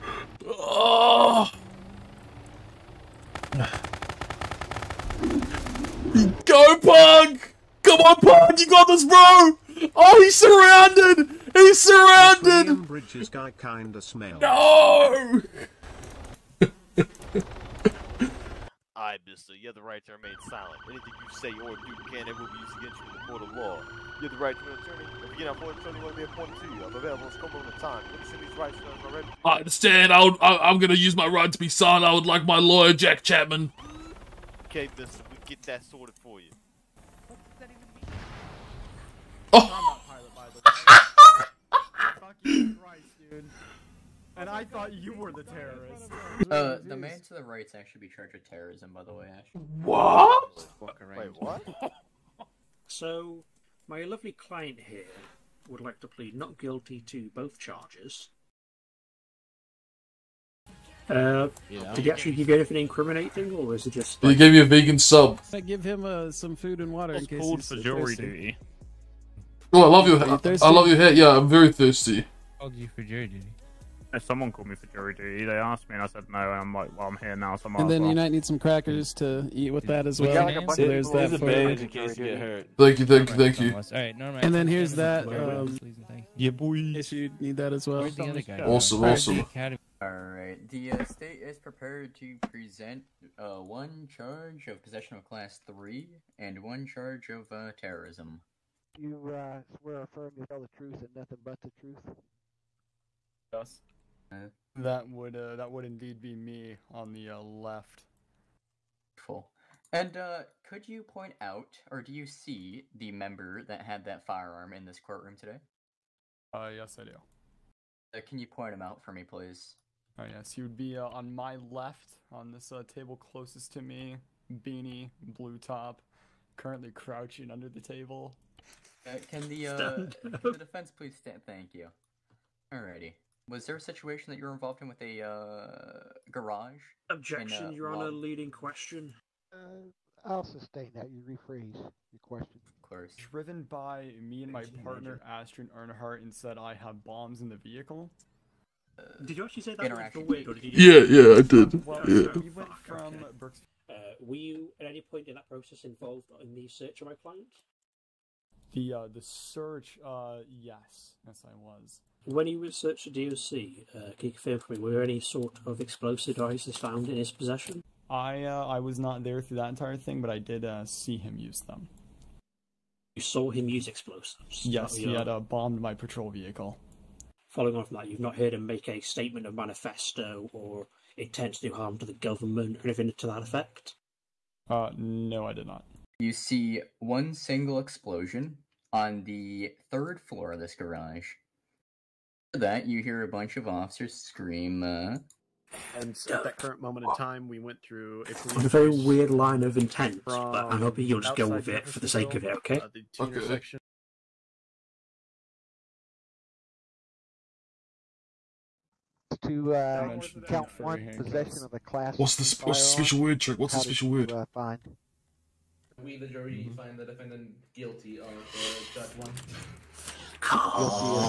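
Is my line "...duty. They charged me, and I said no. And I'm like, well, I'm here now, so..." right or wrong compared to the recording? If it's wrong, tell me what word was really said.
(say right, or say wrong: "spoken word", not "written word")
wrong: "asked", not "charged".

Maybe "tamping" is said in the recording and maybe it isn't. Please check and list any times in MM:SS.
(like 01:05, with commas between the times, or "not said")
not said.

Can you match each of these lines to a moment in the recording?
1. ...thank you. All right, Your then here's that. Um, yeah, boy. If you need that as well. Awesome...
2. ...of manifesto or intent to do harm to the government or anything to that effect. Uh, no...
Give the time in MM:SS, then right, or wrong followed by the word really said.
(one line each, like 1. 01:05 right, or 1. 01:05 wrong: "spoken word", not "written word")
1. 01:23 wrong: "And", not "Your"
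2. 02:59 right.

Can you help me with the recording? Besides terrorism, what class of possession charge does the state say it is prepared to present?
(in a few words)
Class 3.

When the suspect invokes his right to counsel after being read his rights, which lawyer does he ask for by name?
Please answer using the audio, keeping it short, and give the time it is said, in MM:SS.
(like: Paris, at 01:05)
Jack Chapman, at 00:32.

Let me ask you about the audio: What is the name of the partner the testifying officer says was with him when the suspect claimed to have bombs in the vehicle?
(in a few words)
Astrid Earnhardt.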